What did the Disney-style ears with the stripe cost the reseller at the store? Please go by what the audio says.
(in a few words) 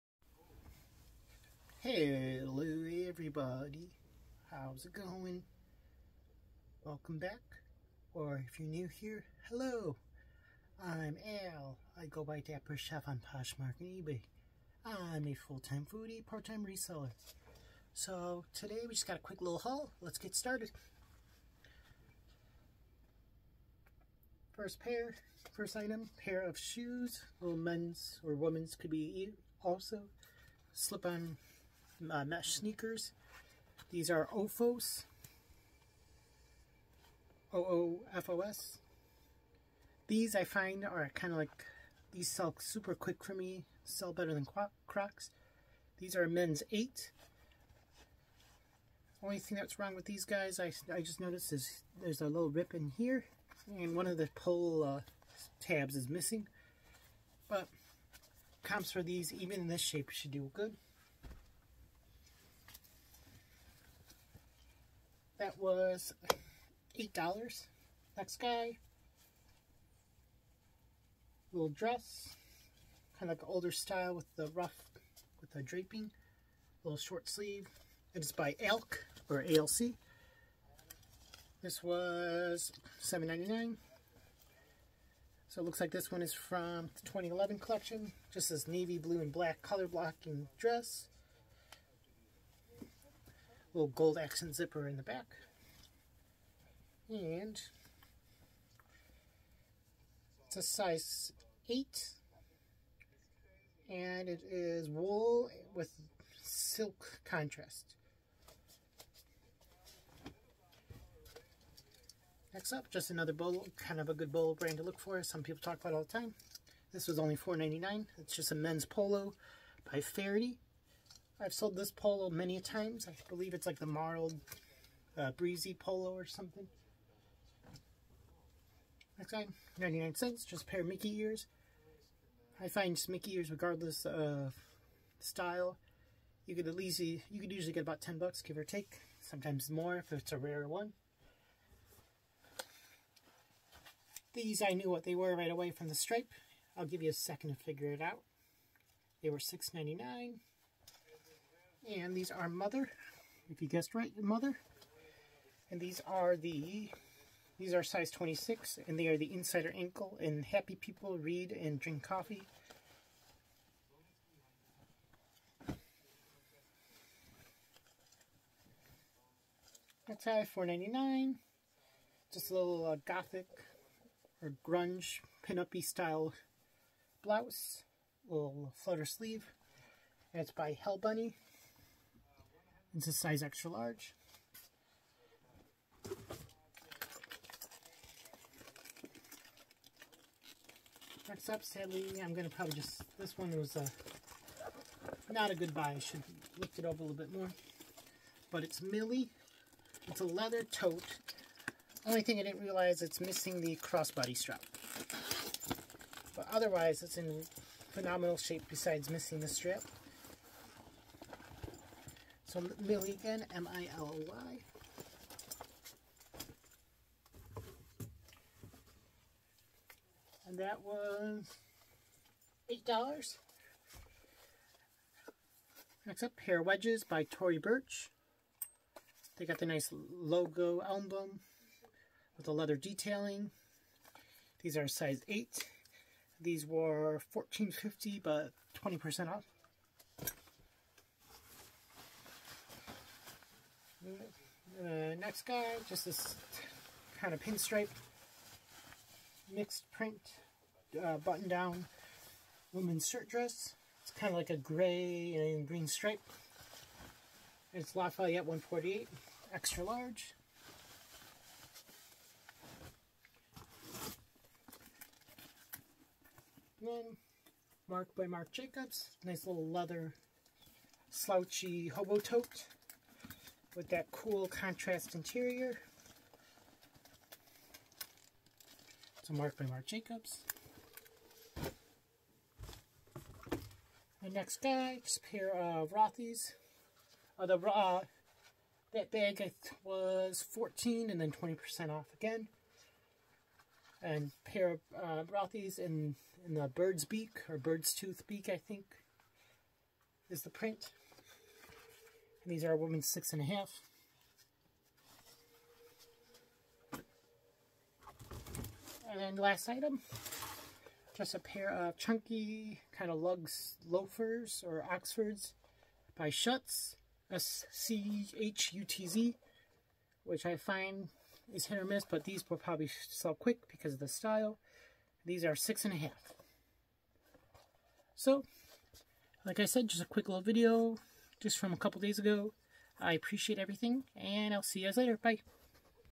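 99 cents.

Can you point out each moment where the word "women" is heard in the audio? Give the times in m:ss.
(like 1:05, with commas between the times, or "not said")
0:28, 5:02.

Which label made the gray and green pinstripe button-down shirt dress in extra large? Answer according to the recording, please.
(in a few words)
Lafayette 148.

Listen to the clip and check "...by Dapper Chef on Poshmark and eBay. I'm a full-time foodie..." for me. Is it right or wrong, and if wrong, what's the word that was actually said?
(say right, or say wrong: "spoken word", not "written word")
right.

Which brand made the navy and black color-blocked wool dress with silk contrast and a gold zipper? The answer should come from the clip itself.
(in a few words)
ALC.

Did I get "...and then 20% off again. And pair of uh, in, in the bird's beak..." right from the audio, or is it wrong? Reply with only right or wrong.
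right.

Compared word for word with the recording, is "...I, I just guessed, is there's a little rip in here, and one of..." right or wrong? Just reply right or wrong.
wrong.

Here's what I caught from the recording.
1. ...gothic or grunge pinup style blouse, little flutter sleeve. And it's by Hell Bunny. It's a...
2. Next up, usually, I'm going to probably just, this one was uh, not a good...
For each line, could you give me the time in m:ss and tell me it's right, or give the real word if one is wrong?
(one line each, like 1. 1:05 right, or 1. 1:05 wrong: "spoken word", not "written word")
1. 2:53 right
2. 3:11 wrong: "sadly", not "usually".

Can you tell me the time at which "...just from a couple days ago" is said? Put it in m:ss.
5:31.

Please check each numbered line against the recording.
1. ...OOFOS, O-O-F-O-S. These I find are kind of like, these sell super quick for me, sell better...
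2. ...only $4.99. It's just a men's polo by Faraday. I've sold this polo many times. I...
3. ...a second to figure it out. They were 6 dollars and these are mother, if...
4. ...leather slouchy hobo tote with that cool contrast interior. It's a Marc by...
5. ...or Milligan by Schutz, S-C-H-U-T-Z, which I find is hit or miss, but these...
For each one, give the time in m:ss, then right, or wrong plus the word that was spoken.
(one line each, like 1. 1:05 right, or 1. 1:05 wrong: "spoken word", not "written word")
1. 0:34 right
2. 1:57 right
3. 2:27 right
4. 4:29 right
5. 5:14 wrong: "Oxfords", not "Milligan".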